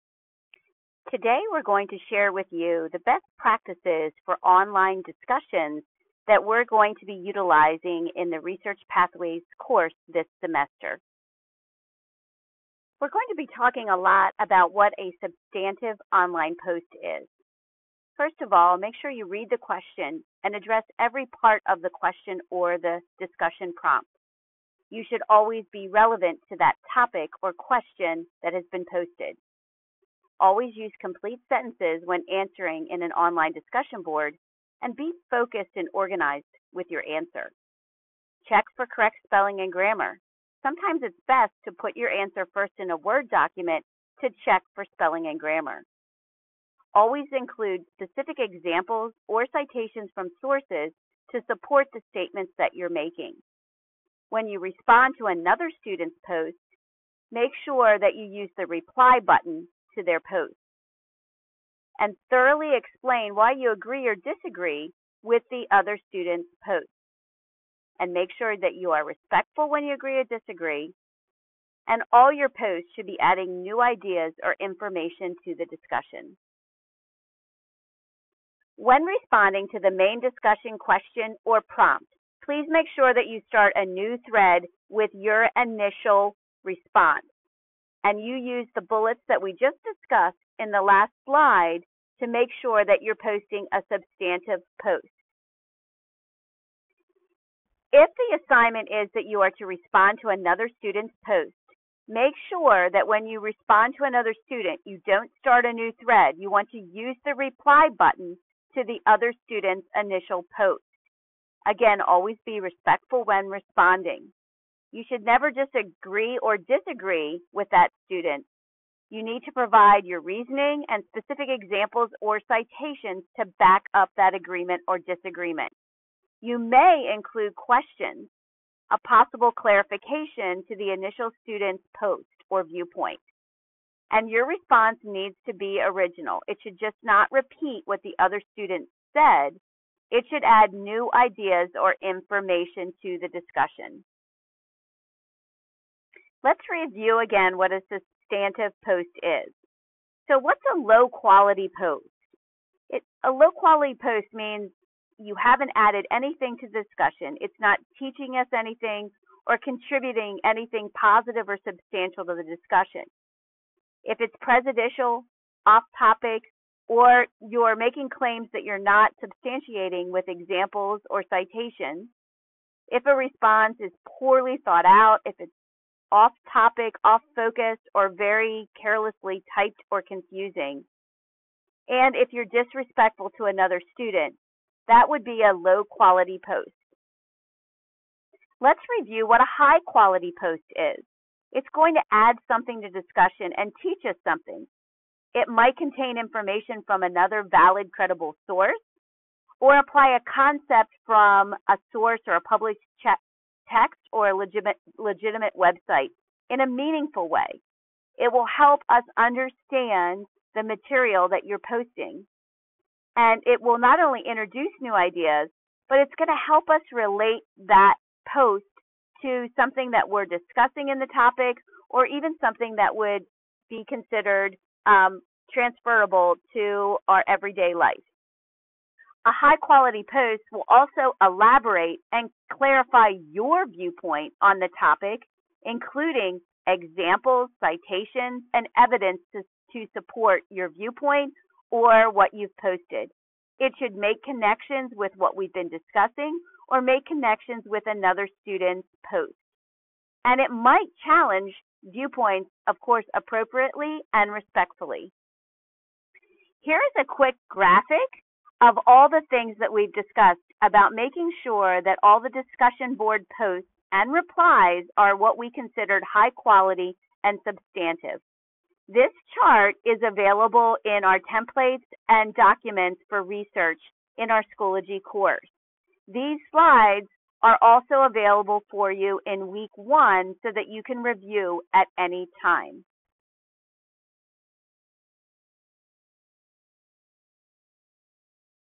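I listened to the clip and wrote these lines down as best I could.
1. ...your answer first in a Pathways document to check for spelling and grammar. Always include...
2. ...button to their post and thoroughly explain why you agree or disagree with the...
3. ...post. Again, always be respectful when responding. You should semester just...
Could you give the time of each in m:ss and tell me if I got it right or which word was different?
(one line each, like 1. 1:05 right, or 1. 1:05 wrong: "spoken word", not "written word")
1. 0:41 wrong: "Word", not "Pathways"
2. 0:59 right
3. 1:50 wrong: "never", not "semester".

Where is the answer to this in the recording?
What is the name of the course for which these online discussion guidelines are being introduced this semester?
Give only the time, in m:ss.
0:08.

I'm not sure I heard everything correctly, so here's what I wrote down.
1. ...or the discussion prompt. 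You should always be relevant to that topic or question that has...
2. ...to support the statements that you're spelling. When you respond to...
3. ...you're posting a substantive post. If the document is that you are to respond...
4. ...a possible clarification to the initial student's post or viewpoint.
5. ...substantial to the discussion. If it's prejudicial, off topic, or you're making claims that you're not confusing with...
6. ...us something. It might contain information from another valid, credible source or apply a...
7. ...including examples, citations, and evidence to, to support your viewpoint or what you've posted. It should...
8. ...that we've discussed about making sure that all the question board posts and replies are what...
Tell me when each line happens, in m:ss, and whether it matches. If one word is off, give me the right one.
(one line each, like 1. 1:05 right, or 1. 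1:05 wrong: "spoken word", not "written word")
1. 0:22 right
2. 0:51 wrong: "making", not "spelling"
3. 1:33 wrong: "assignment", not "document"
4. 2:08 right
5. 2:41 wrong: "substantiating", not "confusing"
6. 3:14 right
7. 3:55 right
8. 4:19 wrong: "discussion", not "question".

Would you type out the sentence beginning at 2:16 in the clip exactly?
It should just not repeat what the other student said.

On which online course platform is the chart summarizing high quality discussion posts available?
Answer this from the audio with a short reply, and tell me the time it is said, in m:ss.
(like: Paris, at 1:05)
Schoology, at 4:34.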